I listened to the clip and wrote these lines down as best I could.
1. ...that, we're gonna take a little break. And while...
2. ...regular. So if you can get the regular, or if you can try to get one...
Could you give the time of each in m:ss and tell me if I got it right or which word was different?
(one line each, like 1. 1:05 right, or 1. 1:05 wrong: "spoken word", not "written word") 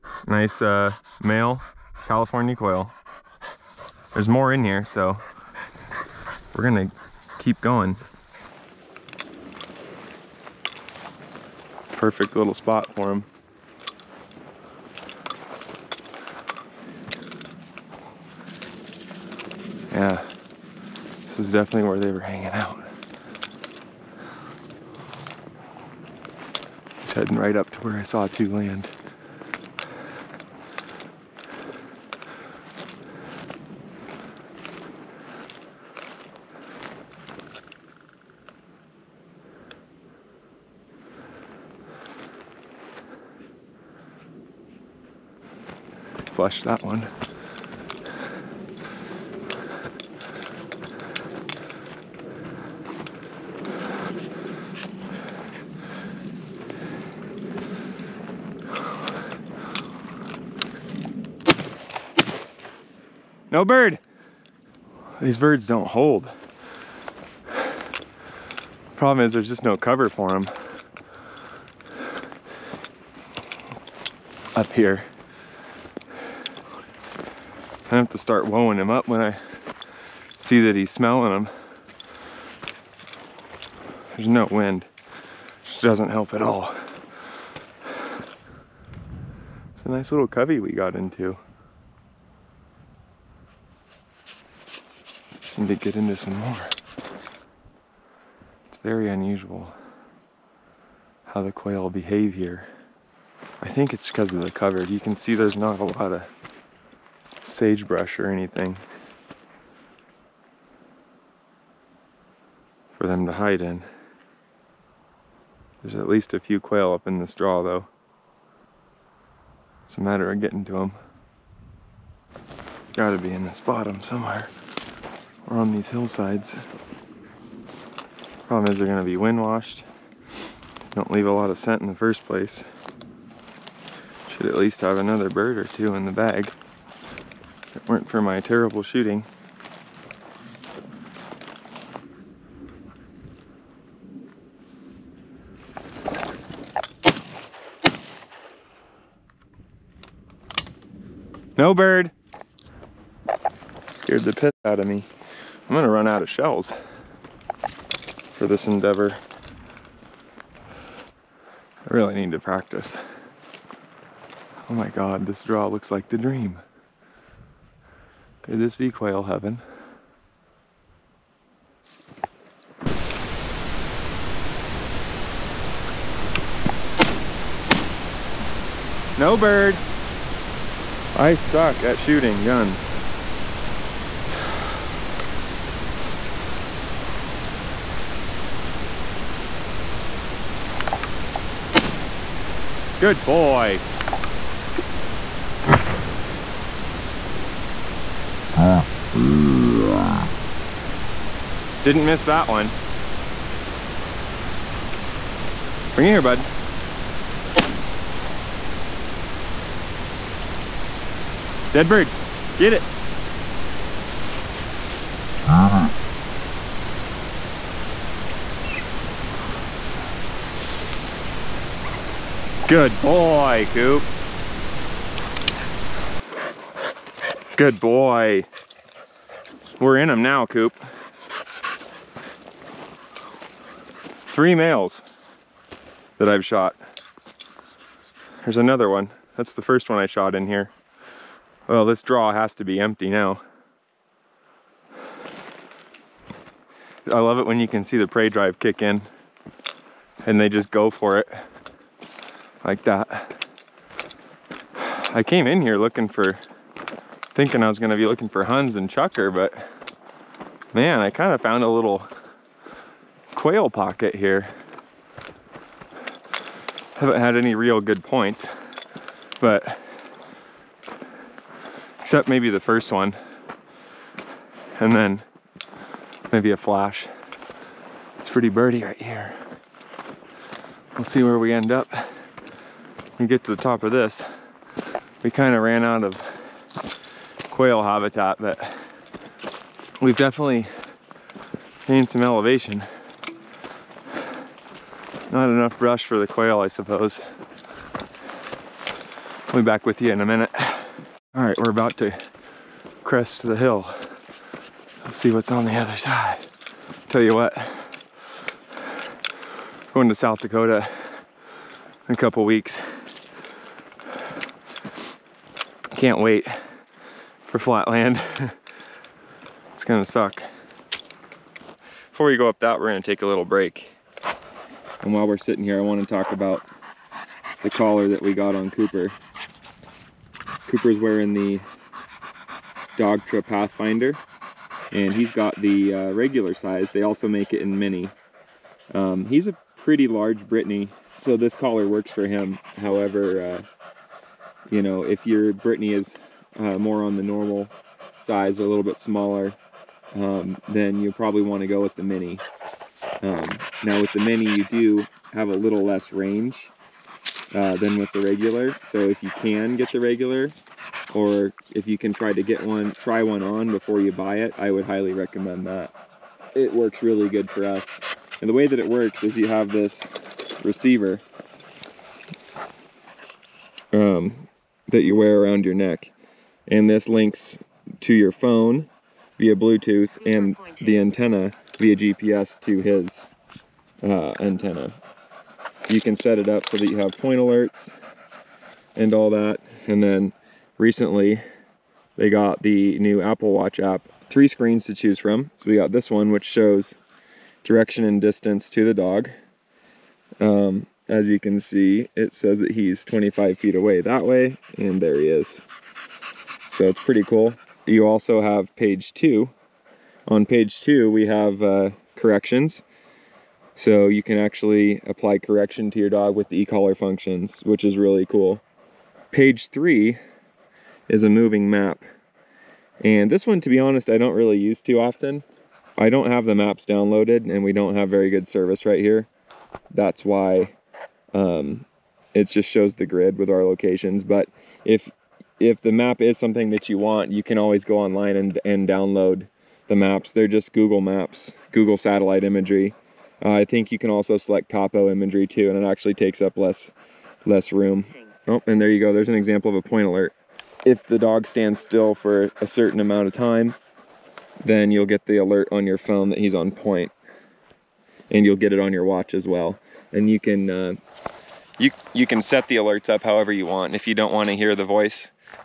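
1. 5:22 right
2. 5:58 right.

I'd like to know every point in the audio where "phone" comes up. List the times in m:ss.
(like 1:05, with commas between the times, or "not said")
6:18, 7:35.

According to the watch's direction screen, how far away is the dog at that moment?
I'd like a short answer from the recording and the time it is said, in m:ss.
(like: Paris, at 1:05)
25 feet, at 6:43.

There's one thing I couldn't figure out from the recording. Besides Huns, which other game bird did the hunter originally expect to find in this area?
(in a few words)
Chukar.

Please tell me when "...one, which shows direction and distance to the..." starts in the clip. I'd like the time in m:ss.
6:36.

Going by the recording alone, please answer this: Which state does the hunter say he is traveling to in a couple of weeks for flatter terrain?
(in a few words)
South Dakota.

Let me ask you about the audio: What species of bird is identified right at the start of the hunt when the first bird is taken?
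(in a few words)
California quail.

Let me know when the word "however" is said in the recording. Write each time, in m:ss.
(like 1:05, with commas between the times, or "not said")
5:42, 7:43.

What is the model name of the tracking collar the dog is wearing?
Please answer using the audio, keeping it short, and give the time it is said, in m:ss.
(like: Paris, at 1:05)
Dogtra Pathfinder, at 5:32.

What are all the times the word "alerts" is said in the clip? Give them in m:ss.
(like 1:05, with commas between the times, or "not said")
6:27, 7:30, 7:35, 7:42.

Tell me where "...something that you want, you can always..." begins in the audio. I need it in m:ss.
7:16.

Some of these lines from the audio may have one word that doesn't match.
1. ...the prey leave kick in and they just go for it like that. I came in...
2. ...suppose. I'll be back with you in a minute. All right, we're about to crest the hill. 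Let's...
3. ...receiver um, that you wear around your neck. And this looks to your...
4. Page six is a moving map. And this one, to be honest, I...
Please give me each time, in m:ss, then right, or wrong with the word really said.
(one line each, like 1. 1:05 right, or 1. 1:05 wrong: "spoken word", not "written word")
1. 4:07 wrong: "drive", not "leave"
2. 4:56 right
3. 6:10 wrong: "links", not "looks"
4. 6:59 wrong: "three", not "six".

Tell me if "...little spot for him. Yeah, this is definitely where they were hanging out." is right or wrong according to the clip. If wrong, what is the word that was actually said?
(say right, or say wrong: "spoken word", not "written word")
right.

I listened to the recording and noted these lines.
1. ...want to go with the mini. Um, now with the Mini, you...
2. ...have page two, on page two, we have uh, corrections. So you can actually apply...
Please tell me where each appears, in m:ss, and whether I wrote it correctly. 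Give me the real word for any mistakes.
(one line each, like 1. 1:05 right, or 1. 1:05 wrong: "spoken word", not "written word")
1. 5:51 right
2. 6:48 right.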